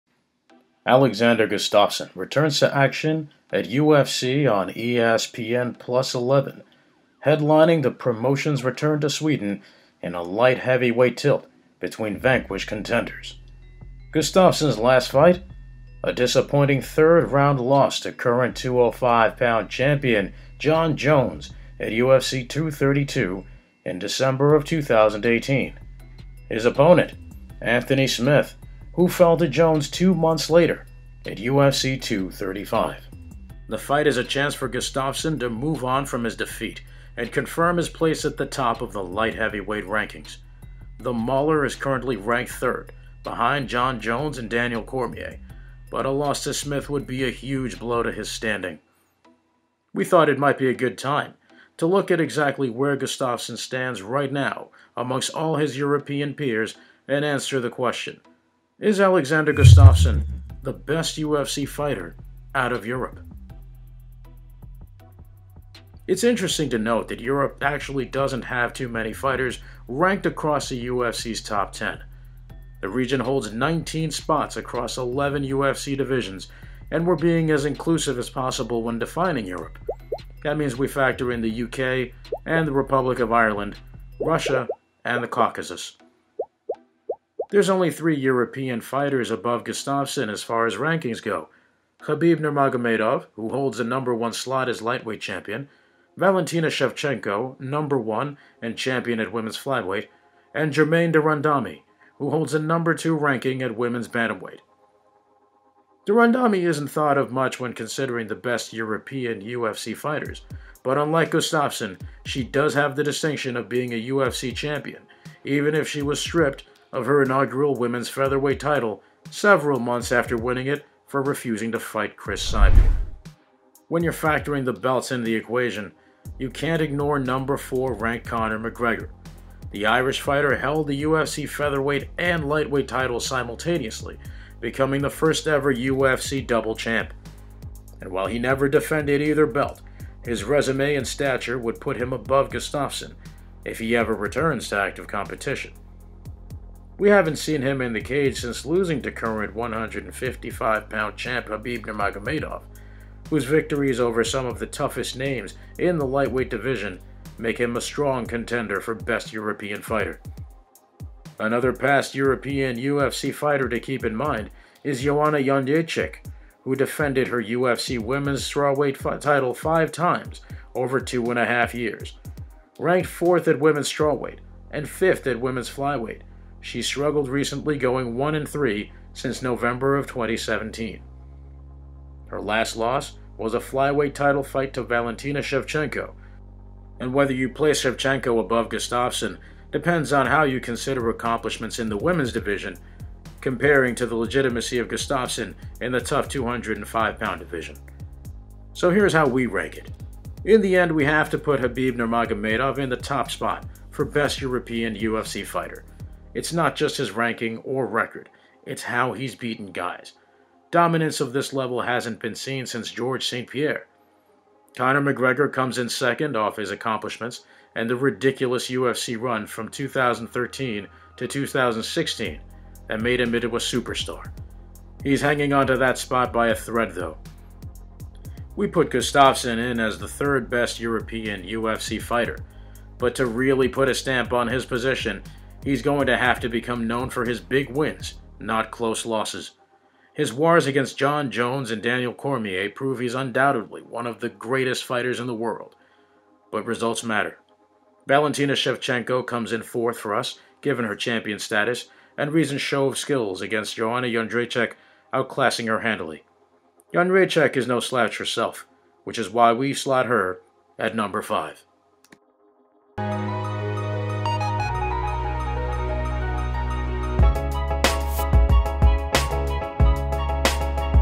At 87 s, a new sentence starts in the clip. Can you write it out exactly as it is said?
There's only three European fighters above Gustafsson as far as rankings go.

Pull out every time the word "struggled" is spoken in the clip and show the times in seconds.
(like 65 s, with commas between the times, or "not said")
176 s.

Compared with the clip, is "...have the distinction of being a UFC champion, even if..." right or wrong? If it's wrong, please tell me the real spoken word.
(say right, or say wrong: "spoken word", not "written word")
right.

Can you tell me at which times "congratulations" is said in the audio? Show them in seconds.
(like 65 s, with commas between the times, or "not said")
not said.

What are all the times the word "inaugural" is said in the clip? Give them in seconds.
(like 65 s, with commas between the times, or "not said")
117 s.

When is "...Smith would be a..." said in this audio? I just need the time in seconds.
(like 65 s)
46 s.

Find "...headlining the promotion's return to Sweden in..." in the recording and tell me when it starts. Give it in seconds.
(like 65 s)
7 s.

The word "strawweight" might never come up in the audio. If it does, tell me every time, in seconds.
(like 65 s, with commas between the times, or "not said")
168 s, 173 s.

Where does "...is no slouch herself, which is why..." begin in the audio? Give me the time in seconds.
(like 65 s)
257 s.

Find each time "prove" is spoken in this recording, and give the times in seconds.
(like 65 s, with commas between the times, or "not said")
242 s.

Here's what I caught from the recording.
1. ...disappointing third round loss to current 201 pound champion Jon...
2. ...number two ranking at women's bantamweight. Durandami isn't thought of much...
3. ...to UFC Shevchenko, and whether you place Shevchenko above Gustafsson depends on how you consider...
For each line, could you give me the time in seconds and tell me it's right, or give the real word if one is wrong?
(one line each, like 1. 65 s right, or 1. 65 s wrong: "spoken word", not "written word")
1. 16 s wrong: "205", not "201"
2. 102 s right
3. 184 s wrong: "Valentina", not "UFC".